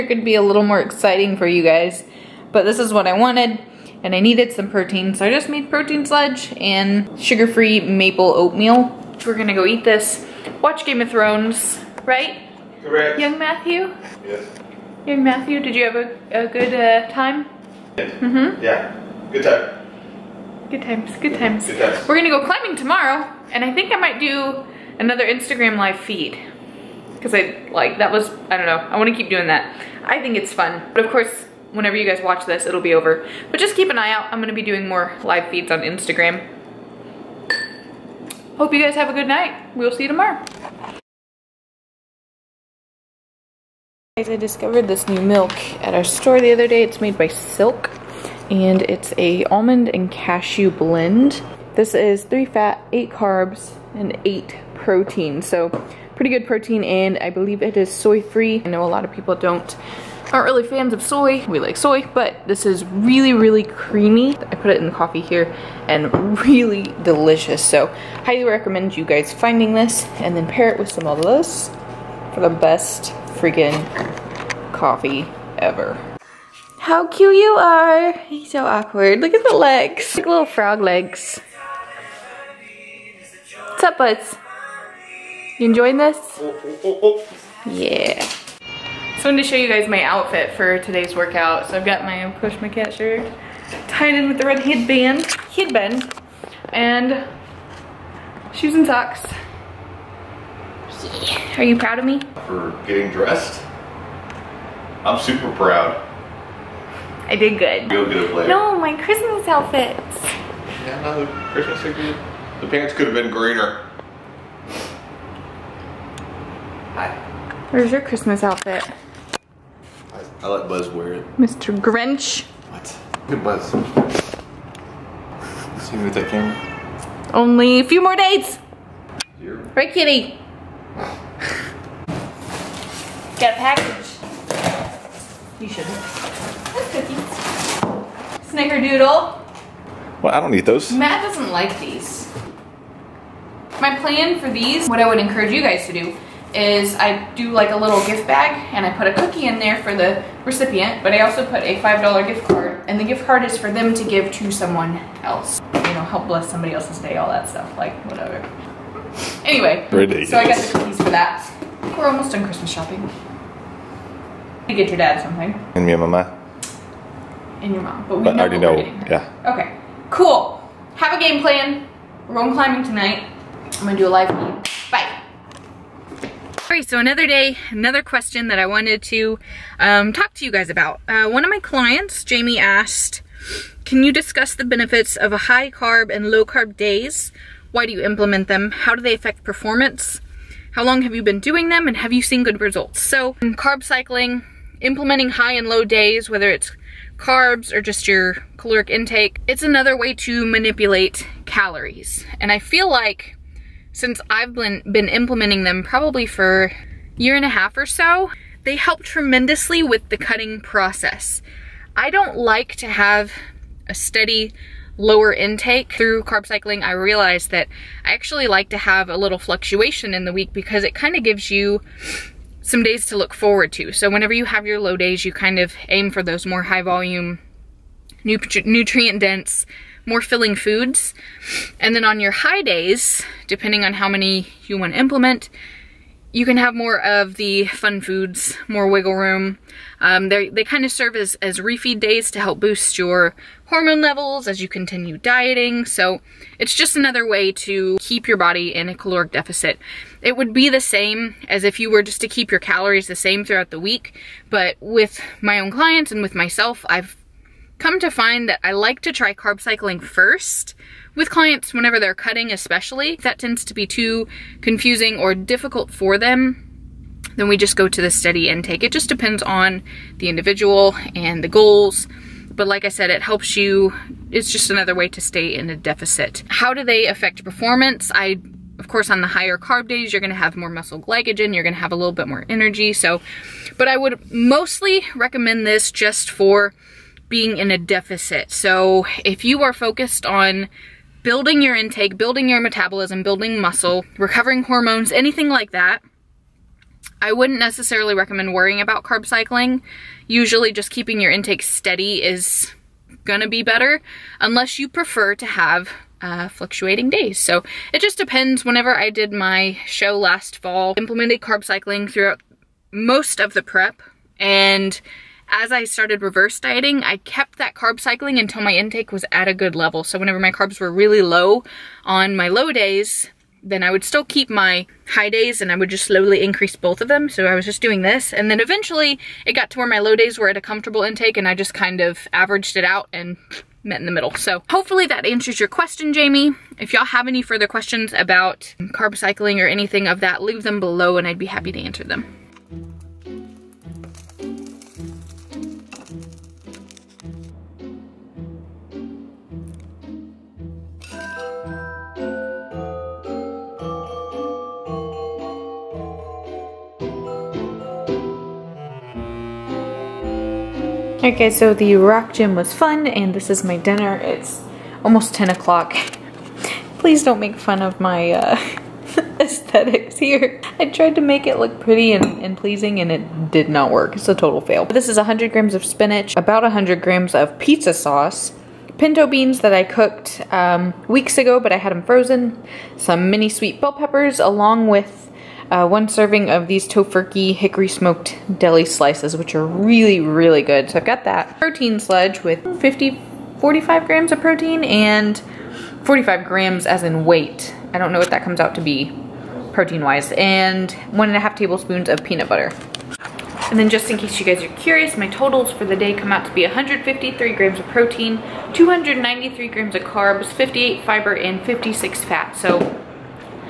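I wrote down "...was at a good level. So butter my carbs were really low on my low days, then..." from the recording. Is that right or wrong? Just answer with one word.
wrong.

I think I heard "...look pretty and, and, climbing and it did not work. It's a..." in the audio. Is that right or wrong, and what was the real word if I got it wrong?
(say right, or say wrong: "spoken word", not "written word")
wrong: "pleasing", not "climbing".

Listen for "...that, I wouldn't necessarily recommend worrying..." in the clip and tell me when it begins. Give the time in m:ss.
4:55.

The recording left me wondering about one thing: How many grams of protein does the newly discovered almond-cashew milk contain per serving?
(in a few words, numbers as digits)
8.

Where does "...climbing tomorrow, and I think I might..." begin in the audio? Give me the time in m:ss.
0:22.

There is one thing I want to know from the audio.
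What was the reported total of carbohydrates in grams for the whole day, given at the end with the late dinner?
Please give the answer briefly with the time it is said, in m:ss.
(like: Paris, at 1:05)
293 grams, at 6:48.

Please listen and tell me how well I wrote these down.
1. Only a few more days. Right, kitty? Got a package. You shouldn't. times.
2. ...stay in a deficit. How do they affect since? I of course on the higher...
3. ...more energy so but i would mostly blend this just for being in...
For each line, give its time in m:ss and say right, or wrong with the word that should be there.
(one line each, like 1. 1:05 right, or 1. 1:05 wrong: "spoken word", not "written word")
1. 2:07 wrong: "cookies", not "times"
2. 4:35 wrong: "performance", not "since"
3. 4:42 wrong: "recommend", not "blend".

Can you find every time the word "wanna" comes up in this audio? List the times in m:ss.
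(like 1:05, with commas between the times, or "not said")
0:28.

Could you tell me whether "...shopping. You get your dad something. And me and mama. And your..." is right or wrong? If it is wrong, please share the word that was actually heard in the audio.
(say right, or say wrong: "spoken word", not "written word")
right.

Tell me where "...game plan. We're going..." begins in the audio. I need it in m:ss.
2:51.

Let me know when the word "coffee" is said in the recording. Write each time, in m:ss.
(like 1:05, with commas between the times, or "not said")
1:04, 1:14.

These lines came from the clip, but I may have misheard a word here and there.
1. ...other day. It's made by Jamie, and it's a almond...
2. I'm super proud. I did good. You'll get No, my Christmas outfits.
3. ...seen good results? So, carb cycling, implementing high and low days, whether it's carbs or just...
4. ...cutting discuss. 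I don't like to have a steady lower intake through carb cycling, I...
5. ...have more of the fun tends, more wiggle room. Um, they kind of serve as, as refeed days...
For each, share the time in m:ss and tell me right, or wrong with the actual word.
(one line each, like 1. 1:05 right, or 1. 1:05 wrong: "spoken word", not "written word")
1. 0:46 wrong: "Silk", not "Jamie"
2. 1:45 right
3. 3:12 right
4. 3:30 wrong: "process", not "discuss"
5. 3:56 wrong: "foods", not "tends".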